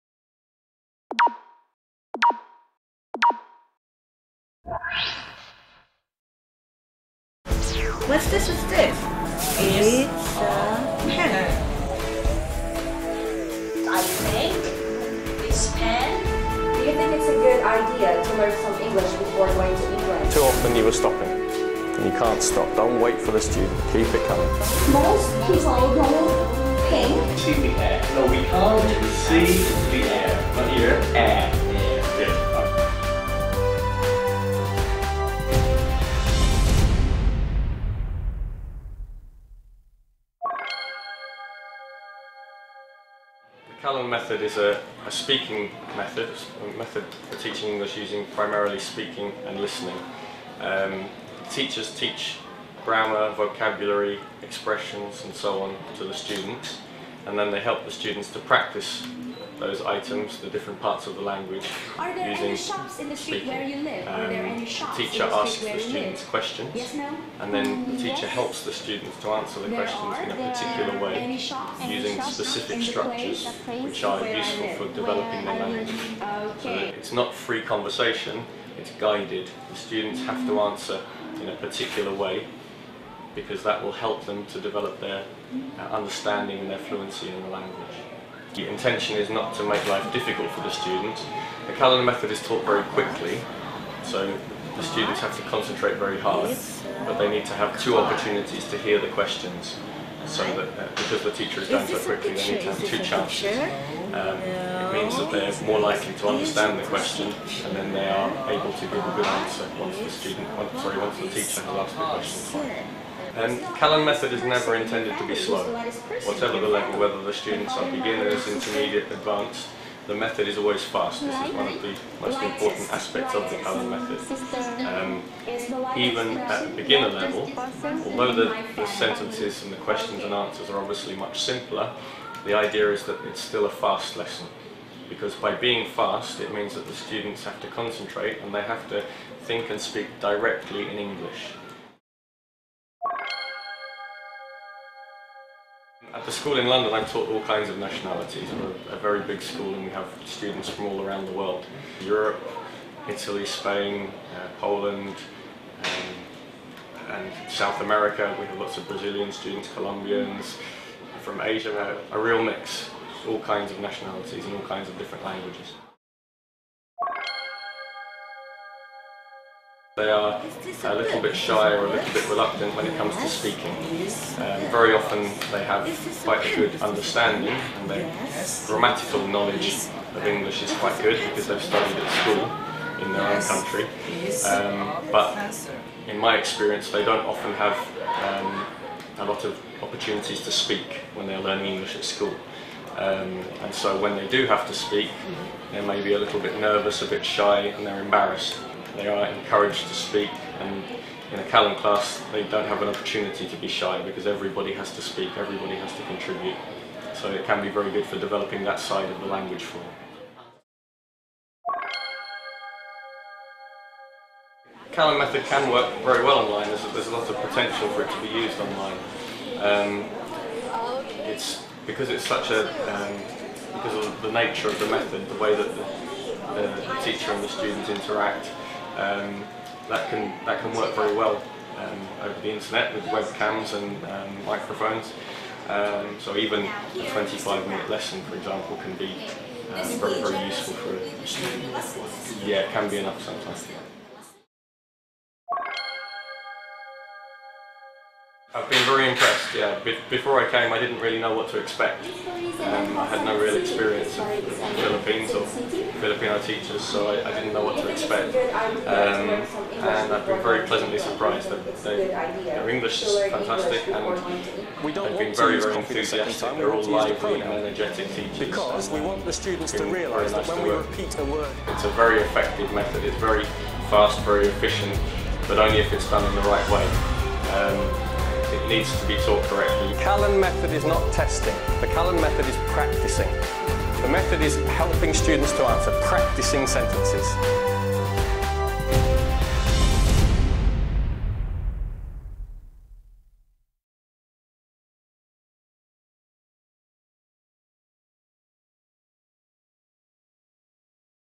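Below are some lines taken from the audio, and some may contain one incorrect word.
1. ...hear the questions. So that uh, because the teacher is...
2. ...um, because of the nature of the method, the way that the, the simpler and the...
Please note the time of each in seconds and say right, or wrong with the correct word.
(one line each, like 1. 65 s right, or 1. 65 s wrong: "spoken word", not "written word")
1. 98 s right
2. 222 s wrong: "teacher", not "simpler".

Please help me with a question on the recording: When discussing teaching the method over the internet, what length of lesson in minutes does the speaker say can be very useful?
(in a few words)
25.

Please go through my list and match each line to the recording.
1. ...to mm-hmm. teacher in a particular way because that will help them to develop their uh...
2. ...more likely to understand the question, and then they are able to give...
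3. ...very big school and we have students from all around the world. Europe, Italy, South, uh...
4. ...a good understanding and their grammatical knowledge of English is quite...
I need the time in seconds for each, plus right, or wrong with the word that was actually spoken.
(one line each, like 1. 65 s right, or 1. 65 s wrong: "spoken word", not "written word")
1. 80 s wrong: "answer", not "teacher"
2. 105 s right
3. 148 s wrong: "Spain", not "South"
4. 176 s right.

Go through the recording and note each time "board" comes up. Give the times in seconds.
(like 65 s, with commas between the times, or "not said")
not said.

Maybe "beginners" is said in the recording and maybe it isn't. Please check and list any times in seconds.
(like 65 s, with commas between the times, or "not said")
117 s, 126 s.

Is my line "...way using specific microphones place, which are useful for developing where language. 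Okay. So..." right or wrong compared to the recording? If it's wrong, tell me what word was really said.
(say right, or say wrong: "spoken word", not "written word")
wrong: "structures", not "microphones".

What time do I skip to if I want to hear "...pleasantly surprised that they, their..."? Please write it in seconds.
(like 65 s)
260 s.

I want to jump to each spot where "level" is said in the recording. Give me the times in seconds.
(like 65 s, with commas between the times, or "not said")
116 s, 127 s.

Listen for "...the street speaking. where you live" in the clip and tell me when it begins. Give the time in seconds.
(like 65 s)
63 s.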